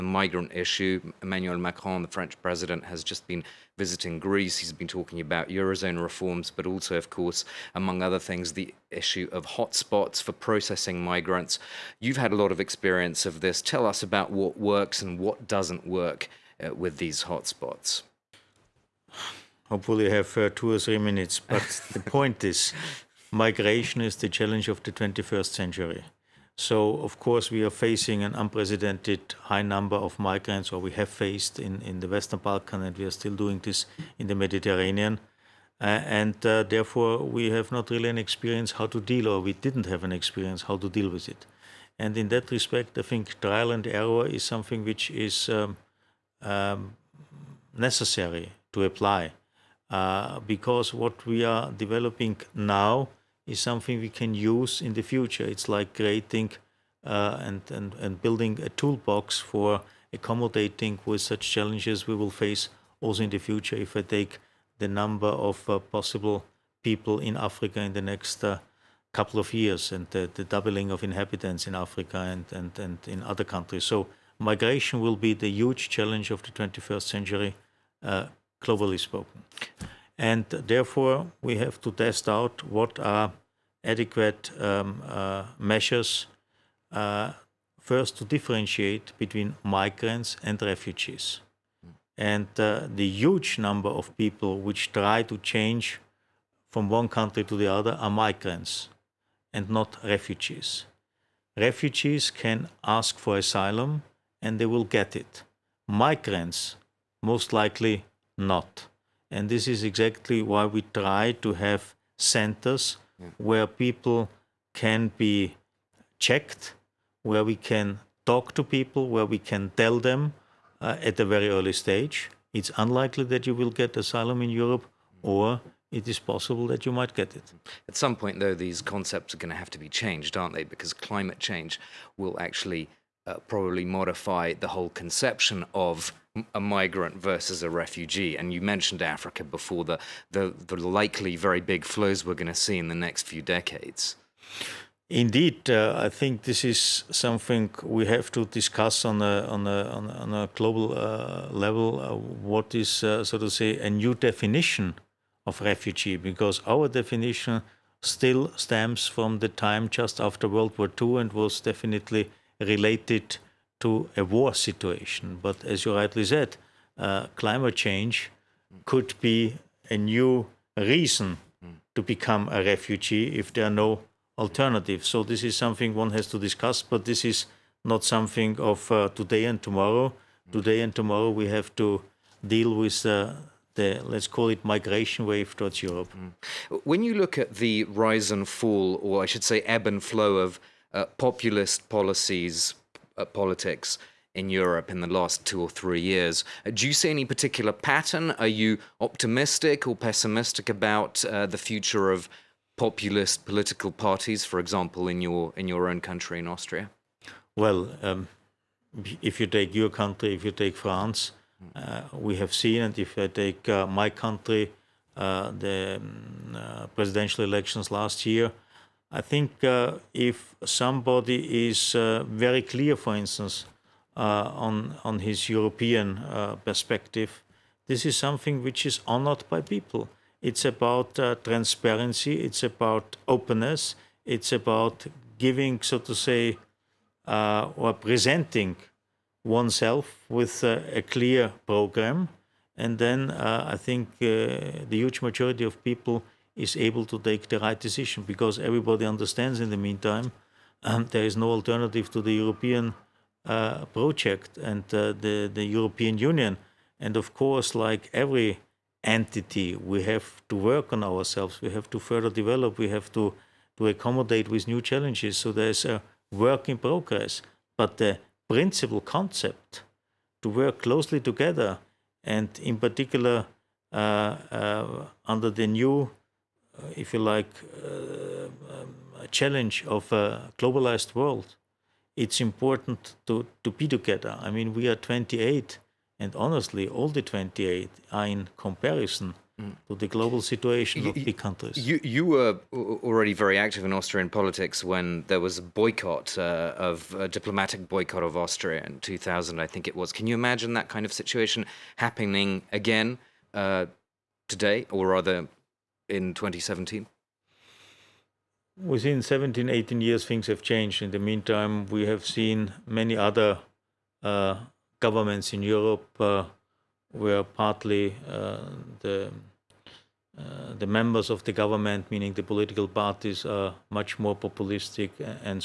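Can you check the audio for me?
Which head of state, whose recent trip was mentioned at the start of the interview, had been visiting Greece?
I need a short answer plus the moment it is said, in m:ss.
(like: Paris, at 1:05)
Emmanuel Macron, at 0:01.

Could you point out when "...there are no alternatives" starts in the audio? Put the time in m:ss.
2:53.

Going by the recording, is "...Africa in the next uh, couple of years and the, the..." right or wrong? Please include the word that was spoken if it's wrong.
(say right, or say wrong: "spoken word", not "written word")
right.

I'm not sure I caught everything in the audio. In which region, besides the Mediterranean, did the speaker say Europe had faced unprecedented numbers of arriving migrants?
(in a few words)
Western Balkan.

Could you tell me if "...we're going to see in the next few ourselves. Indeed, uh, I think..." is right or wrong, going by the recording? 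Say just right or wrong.
wrong.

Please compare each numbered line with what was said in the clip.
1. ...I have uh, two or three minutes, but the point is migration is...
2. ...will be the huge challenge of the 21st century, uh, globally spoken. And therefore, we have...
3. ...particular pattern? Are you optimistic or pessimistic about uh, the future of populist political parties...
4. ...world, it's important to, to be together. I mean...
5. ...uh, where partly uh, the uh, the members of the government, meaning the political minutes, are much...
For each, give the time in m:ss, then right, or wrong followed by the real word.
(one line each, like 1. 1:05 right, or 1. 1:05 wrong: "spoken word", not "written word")
1. 0:20 right
2. 1:15 right
3. 3:17 right
4. 4:41 right
5. 5:16 wrong: "parties", not "minutes".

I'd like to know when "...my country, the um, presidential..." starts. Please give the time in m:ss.
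3:33.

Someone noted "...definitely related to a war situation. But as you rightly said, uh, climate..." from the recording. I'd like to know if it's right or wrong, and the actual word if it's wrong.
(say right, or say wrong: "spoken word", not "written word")
right.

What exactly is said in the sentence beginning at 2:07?
At some point, though, these concepts are going to have to be changed, aren't they?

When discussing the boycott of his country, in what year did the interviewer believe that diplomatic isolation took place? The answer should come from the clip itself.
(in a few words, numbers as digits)
2000.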